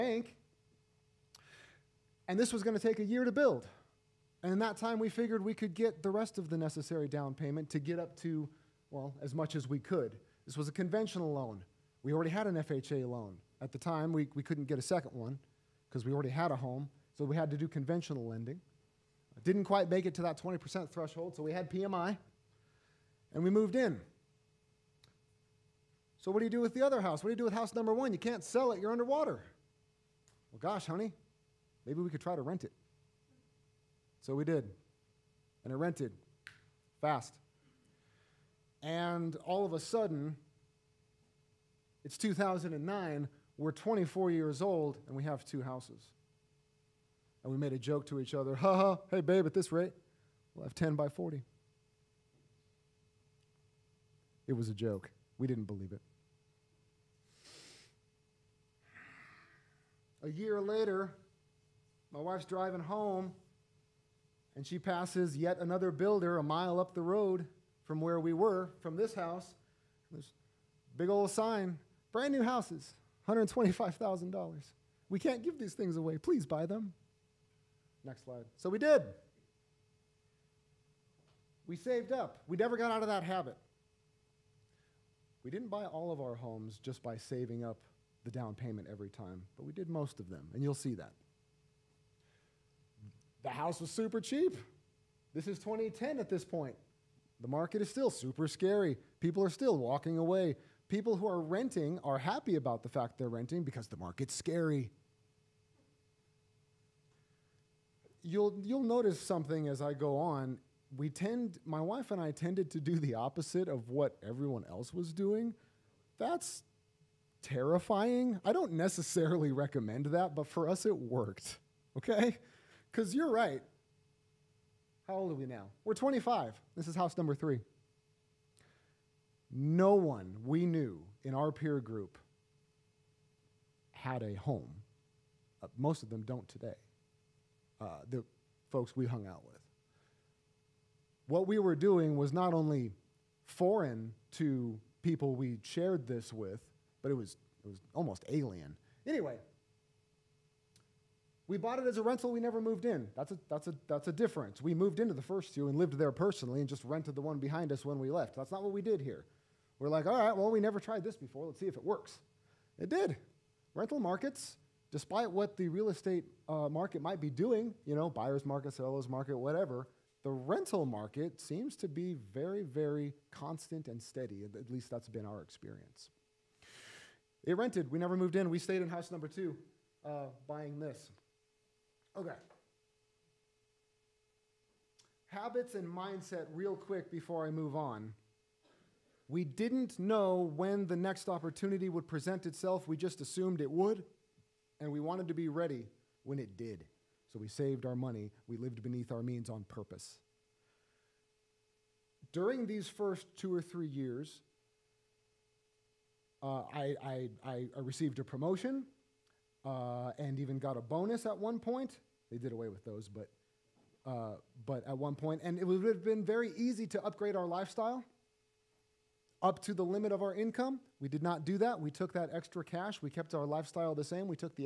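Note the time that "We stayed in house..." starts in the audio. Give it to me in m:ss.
2:58.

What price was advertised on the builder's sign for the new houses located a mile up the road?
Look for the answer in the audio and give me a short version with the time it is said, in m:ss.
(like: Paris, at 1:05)
$125,000, at 1:13.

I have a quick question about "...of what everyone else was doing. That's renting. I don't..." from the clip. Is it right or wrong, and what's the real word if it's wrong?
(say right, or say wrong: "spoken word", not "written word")
wrong: "terrifying", not "renting".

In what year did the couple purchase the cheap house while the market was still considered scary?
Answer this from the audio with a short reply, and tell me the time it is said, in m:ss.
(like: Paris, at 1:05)
2010, at 1:35.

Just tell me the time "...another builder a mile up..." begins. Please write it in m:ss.
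1:05.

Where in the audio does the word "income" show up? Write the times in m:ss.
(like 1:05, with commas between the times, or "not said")
3:40.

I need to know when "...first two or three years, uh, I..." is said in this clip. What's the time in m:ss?
3:22.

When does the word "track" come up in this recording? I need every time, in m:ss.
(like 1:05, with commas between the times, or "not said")
not said.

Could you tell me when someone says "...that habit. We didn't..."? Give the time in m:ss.
1:23.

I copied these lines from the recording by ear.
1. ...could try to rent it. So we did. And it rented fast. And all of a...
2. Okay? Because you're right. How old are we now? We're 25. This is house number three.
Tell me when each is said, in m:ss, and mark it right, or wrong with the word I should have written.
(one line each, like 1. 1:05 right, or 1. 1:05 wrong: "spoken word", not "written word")
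1. 0:32 right
2. 2:01 right.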